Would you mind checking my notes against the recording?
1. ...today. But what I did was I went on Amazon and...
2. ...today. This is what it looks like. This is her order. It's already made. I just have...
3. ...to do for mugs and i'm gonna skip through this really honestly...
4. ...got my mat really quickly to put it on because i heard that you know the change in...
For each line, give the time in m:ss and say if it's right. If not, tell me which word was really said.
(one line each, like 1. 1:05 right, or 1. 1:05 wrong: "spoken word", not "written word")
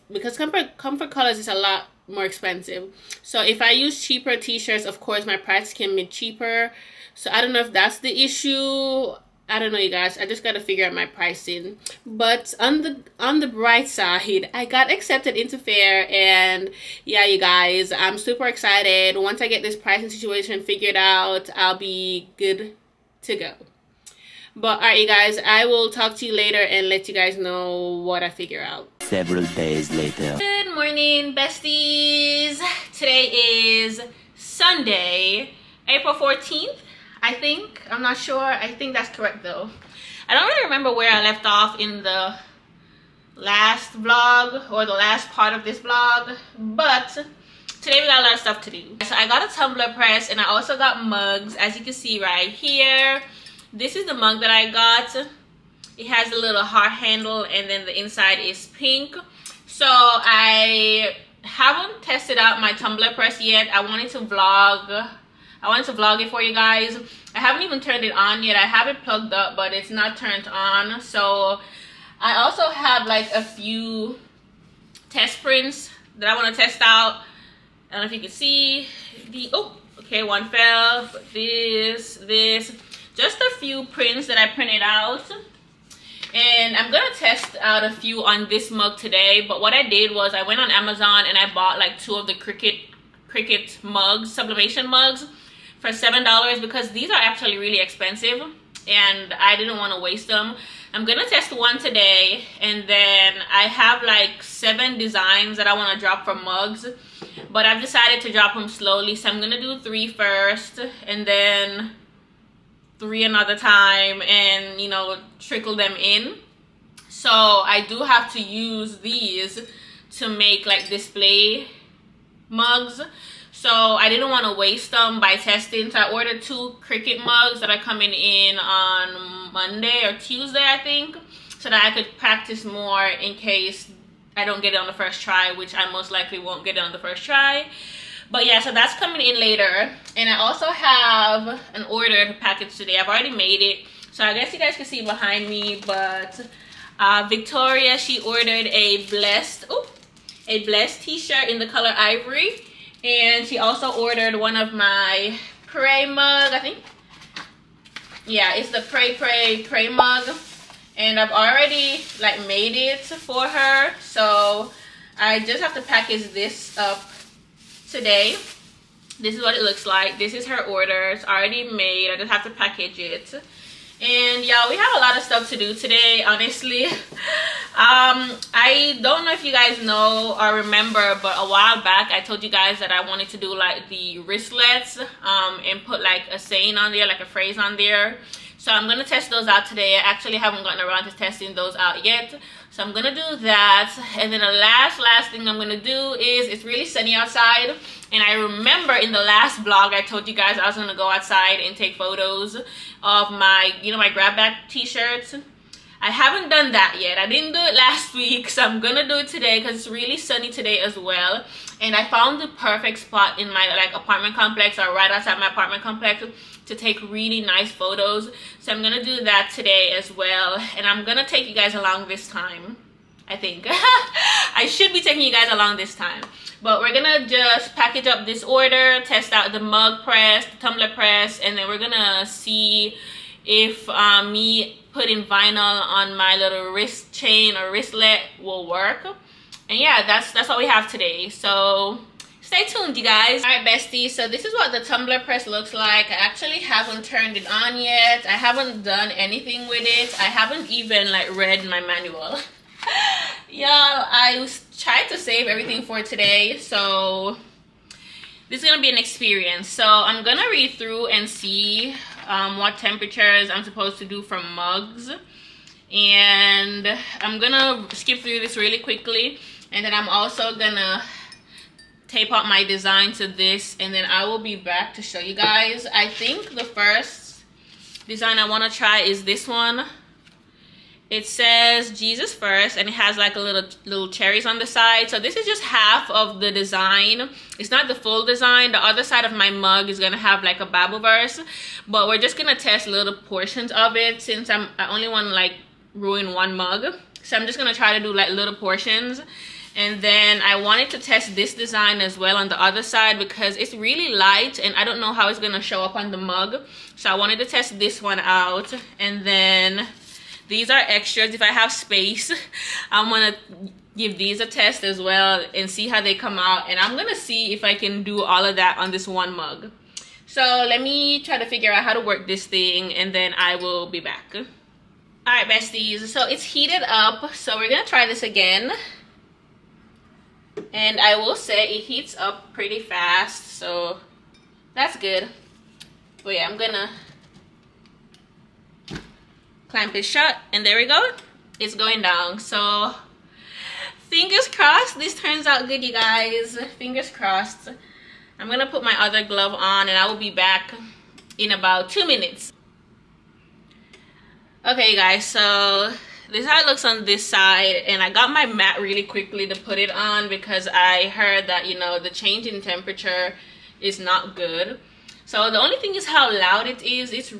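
1. 1:28 right
2. 2:47 right
3. 4:23 wrong: "quickly", not "honestly"
4. 5:58 right.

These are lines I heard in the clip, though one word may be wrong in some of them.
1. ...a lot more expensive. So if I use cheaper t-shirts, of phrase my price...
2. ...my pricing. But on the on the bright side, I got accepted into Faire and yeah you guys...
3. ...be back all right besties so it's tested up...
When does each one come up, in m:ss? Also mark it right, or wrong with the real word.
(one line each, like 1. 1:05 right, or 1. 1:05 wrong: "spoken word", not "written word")
1. 0:01 wrong: "course", not "phrase"
2. 0:10 right
3. 5:23 wrong: "heated", not "tested".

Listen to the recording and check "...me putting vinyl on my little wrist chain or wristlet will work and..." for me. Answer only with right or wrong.
right.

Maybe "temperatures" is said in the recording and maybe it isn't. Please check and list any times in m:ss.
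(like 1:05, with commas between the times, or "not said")
4:22, 6:02.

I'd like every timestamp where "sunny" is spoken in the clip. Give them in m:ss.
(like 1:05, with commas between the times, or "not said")
3:16, 3:30.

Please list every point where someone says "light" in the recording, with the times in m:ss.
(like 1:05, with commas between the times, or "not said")
5:04.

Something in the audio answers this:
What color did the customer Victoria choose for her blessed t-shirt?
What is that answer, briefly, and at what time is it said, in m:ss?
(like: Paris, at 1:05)
ivory, at 2:31.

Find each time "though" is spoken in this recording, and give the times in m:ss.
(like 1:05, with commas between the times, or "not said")
0:39.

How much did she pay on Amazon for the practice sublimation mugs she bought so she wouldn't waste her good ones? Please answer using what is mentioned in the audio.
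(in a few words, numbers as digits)
$7.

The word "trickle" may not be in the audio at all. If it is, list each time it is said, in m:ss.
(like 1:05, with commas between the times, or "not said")
1:55.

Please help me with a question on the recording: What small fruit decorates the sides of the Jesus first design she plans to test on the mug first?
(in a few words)
cherries.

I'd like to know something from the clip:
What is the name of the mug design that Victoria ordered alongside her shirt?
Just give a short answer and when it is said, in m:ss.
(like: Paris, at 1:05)
pray pray pray, at 2:38.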